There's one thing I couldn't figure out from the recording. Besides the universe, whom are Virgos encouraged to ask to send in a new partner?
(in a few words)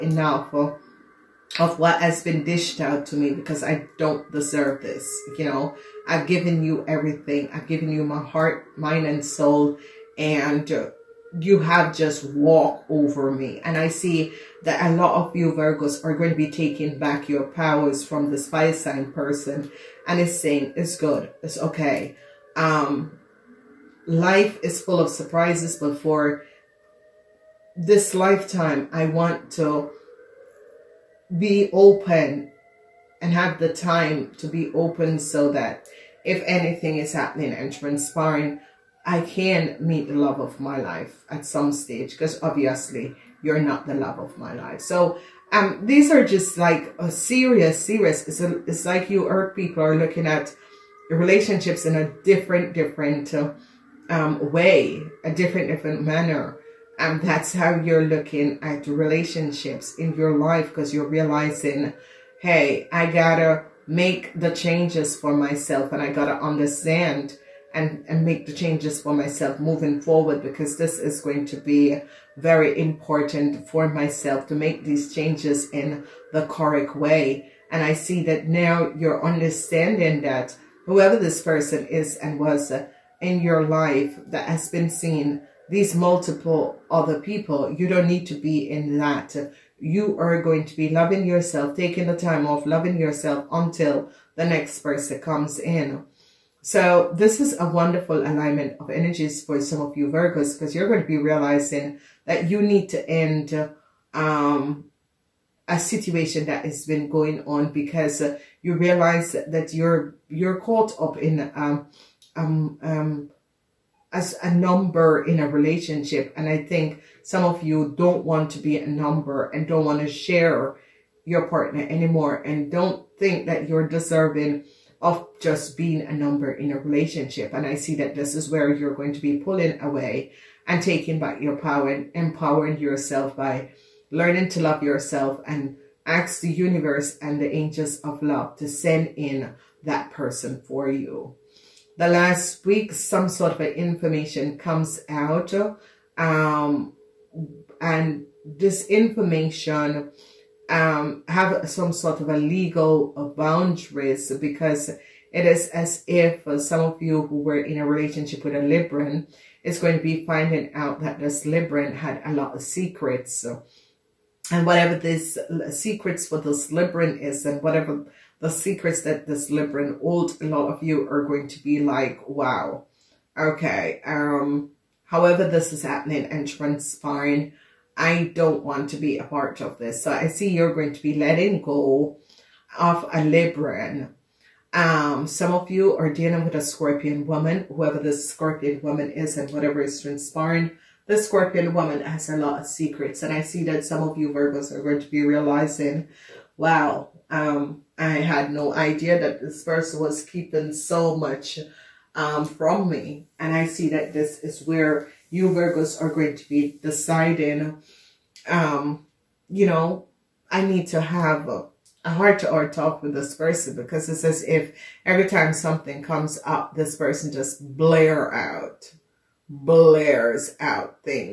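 angels of love.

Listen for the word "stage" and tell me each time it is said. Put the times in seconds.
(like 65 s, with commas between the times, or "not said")
41 s.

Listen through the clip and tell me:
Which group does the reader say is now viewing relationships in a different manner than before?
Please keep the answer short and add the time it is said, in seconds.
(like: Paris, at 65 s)
earth people, at 49 s.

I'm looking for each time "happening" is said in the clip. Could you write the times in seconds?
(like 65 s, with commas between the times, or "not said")
37 s, 175 s.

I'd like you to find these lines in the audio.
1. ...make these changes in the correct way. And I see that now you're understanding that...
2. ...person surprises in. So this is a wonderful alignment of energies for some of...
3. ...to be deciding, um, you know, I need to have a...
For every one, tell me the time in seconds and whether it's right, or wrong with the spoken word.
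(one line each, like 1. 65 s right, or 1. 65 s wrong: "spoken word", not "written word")
1. 74 s right
2. 94 s wrong: "comes", not "surprises"
3. 206 s right.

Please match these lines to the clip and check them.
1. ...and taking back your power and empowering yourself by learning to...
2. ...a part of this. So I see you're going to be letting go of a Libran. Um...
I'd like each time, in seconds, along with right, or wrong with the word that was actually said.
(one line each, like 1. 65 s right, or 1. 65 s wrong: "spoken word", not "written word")
1. 130 s right
2. 179 s right.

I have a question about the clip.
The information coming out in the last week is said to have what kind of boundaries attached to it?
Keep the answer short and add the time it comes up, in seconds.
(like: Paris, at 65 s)
legal, at 152 s.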